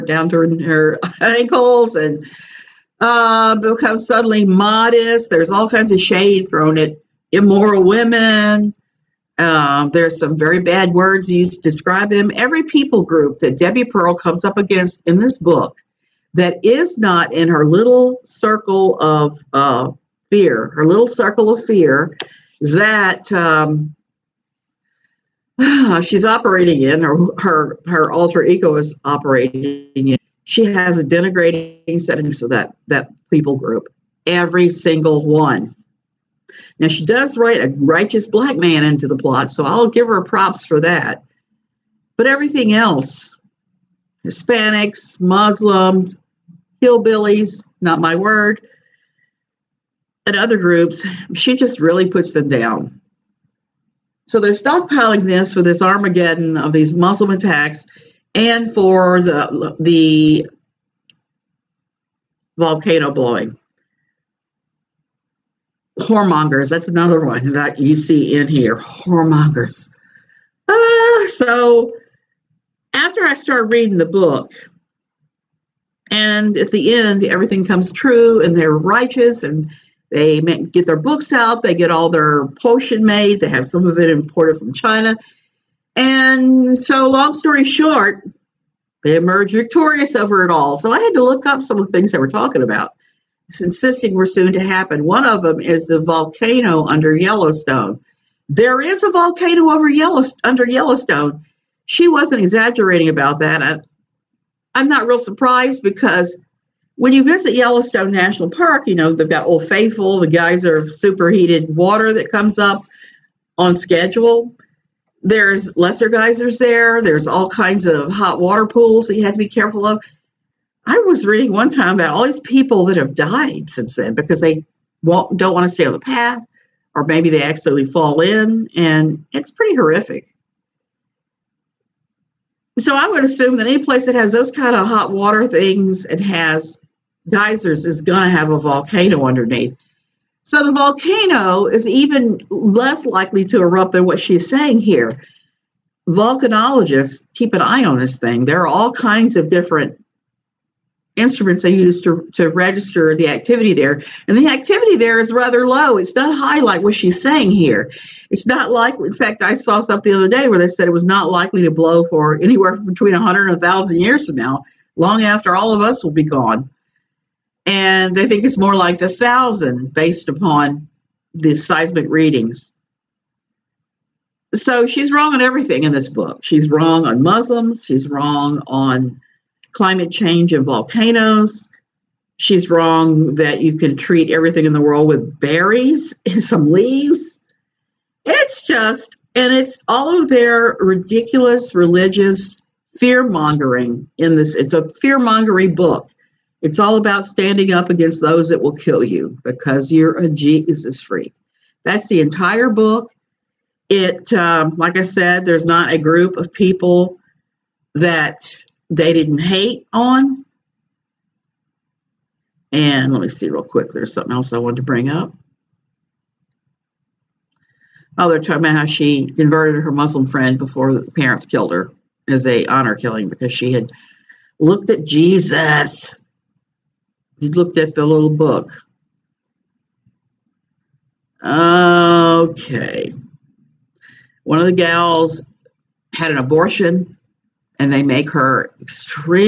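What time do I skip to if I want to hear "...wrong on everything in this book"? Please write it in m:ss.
2:55.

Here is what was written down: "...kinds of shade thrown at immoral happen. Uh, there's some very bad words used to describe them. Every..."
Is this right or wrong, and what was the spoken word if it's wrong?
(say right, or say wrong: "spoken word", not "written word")
wrong: "women", not "happen".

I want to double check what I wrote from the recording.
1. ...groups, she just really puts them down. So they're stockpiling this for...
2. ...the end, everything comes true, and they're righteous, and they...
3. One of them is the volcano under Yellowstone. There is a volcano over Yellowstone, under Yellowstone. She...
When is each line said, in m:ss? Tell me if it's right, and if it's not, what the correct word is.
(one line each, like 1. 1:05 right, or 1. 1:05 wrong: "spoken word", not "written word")
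1. 0:50 right
2. 1:16 right
3. 1:35 right.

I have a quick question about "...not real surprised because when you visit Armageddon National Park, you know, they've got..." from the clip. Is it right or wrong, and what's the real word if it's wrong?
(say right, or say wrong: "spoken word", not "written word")
wrong: "Yellowstone", not "Armageddon".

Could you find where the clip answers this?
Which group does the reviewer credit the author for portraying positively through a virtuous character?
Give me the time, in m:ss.
0:37.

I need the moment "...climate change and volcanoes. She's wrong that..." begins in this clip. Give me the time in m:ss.
2:59.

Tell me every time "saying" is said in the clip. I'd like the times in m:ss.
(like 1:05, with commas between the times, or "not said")
2:24, 2:37.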